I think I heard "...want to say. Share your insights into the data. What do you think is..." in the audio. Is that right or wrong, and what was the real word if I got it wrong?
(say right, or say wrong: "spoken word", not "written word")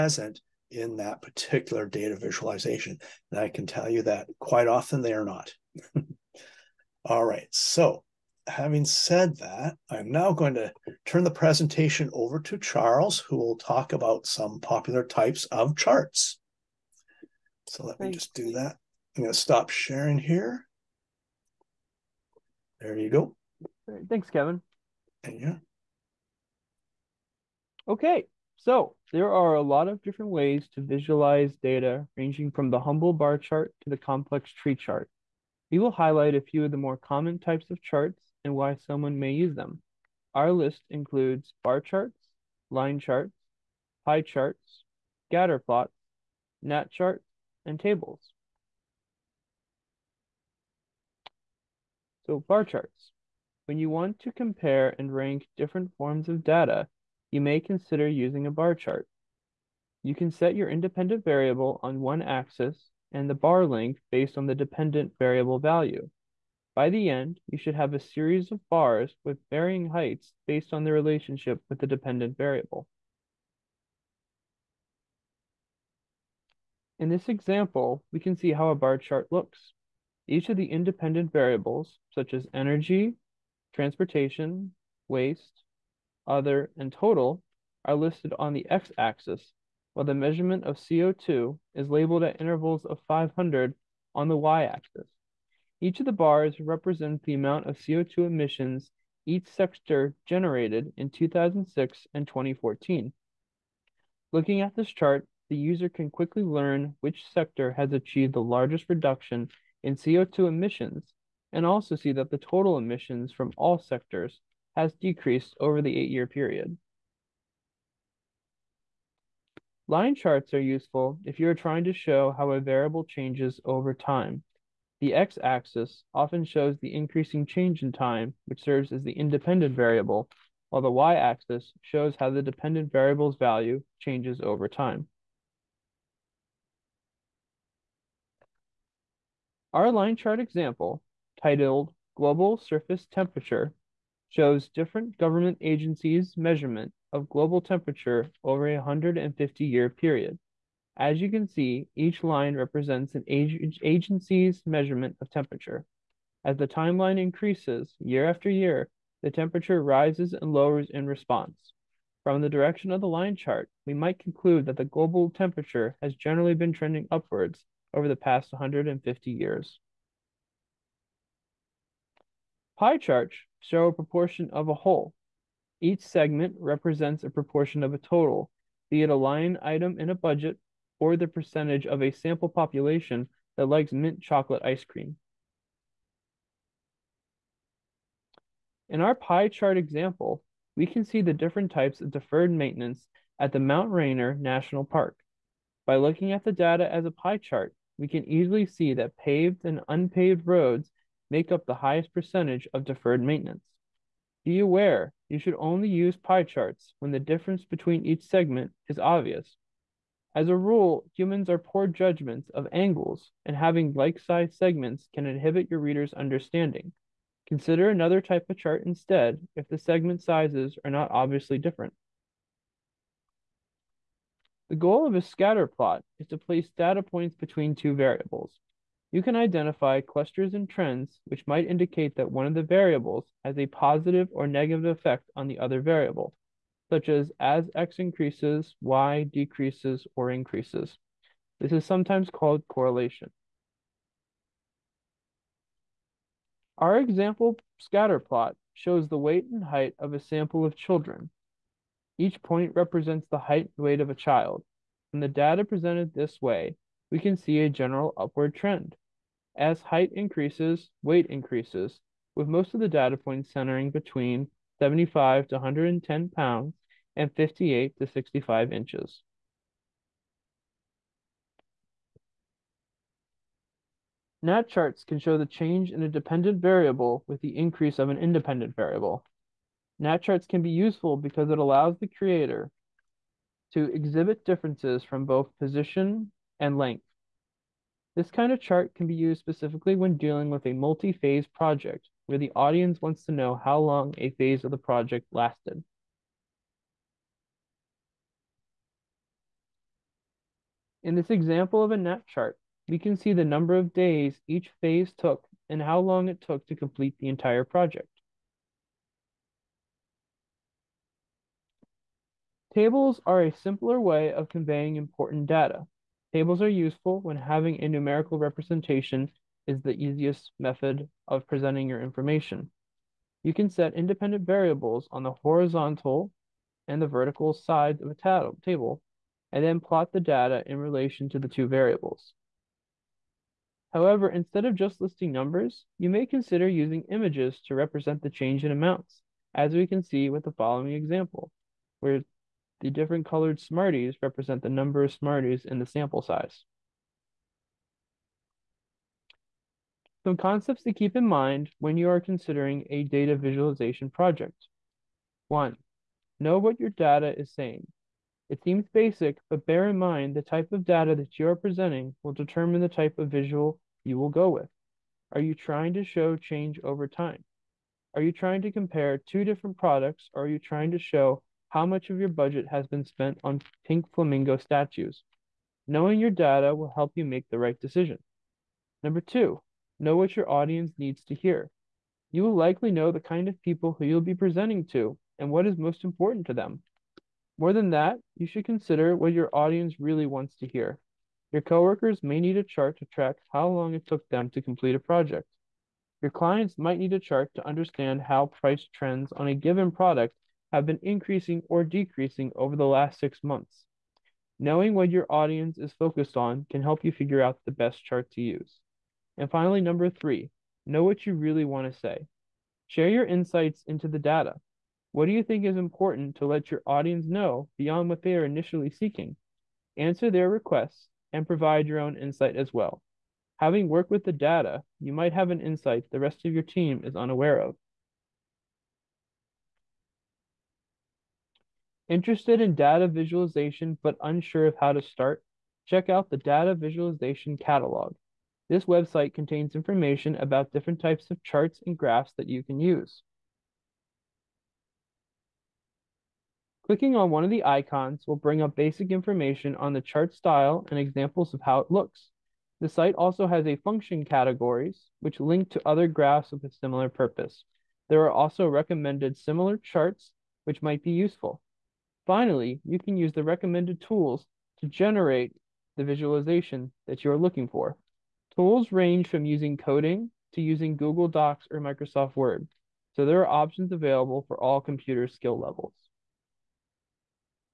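right.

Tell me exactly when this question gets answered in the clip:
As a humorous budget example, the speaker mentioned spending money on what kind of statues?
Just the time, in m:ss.
6:13.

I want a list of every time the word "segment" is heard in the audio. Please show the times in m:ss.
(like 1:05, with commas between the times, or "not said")
2:56, 3:28, 3:34, 3:39.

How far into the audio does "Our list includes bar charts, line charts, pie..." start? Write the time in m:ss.
0:40.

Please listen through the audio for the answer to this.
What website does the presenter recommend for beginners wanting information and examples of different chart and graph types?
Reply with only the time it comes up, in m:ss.
7:16.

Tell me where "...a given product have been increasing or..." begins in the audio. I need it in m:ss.
6:39.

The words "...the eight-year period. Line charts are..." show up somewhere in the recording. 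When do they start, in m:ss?
1:55.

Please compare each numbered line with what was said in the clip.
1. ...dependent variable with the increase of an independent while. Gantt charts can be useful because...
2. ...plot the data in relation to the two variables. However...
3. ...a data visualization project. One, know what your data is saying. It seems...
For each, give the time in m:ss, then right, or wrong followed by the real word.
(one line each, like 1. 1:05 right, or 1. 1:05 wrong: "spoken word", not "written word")
1. 4:36 wrong: "variable", not "while"
2. 5:29 right
3. 5:52 right.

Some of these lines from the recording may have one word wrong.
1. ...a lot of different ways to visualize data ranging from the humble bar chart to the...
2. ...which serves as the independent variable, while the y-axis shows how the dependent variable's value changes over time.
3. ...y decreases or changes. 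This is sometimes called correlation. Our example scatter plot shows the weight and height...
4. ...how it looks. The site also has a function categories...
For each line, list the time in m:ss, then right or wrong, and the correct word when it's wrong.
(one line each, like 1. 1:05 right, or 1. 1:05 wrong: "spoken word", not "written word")
1. 0:29 right
2. 2:08 right
3. 3:58 wrong: "increases", not "changes"
4. 7:31 right.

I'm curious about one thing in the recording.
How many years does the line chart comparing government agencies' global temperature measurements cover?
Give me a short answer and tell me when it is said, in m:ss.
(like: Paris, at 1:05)
150, at 2:28.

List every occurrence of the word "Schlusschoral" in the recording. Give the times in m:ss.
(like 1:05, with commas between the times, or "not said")
not said.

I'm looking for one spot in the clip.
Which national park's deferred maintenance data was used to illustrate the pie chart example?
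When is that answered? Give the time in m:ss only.
3:13.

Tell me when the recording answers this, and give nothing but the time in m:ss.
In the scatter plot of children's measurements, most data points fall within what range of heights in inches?
4:27.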